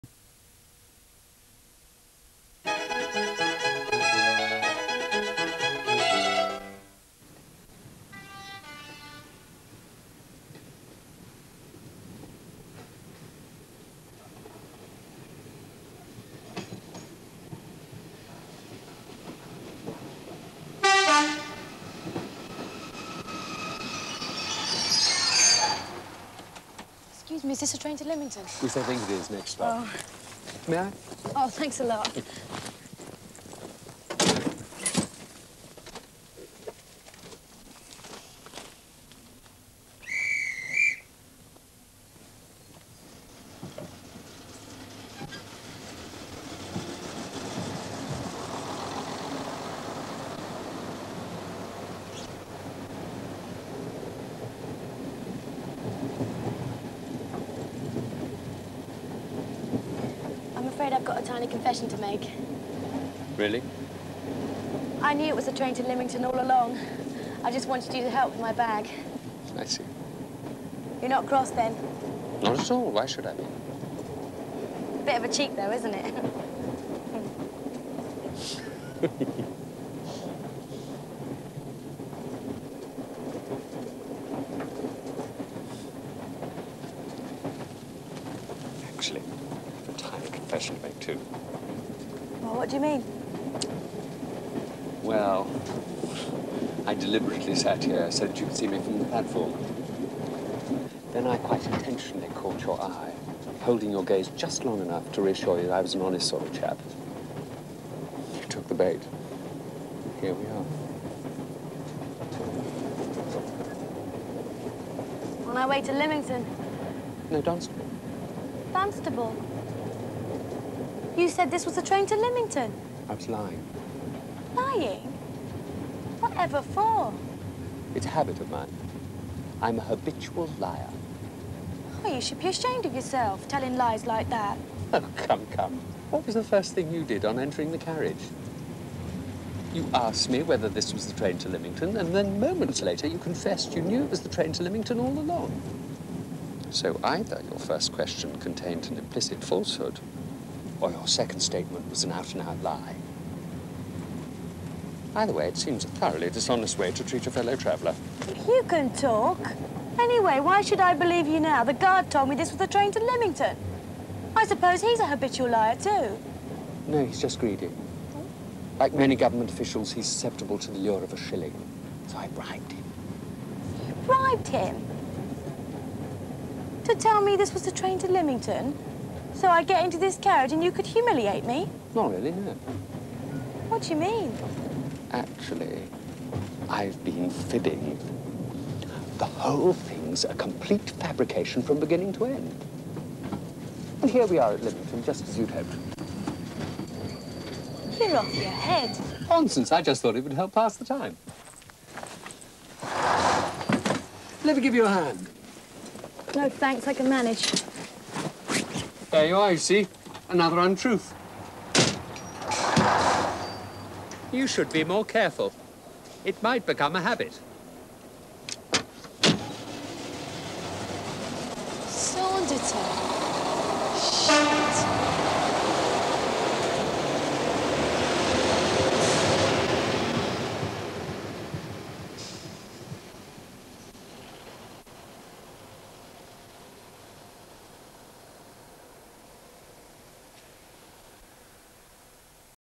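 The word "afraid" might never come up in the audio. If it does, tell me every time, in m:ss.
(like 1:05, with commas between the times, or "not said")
1:00.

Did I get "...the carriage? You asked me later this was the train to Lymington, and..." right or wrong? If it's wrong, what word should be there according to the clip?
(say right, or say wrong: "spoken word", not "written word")
wrong: "whether", not "later".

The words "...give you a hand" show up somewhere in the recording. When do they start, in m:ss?
3:24.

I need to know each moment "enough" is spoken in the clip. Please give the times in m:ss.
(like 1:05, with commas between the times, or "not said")
1:44.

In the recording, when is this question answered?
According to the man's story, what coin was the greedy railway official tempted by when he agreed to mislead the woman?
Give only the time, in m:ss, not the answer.
2:51.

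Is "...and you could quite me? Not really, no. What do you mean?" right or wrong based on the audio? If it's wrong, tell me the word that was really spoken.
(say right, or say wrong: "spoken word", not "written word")
wrong: "humiliate", not "quite".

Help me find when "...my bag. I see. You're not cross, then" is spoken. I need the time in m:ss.
1:08.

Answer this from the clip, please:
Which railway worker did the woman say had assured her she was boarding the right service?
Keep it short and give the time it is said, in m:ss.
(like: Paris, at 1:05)
The guard, at 2:41.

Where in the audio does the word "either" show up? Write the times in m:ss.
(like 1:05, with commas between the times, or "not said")
2:27, 2:35.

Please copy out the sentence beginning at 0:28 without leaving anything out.
We I think it is, next stop.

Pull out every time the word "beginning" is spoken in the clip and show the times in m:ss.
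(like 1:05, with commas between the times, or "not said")
3:11.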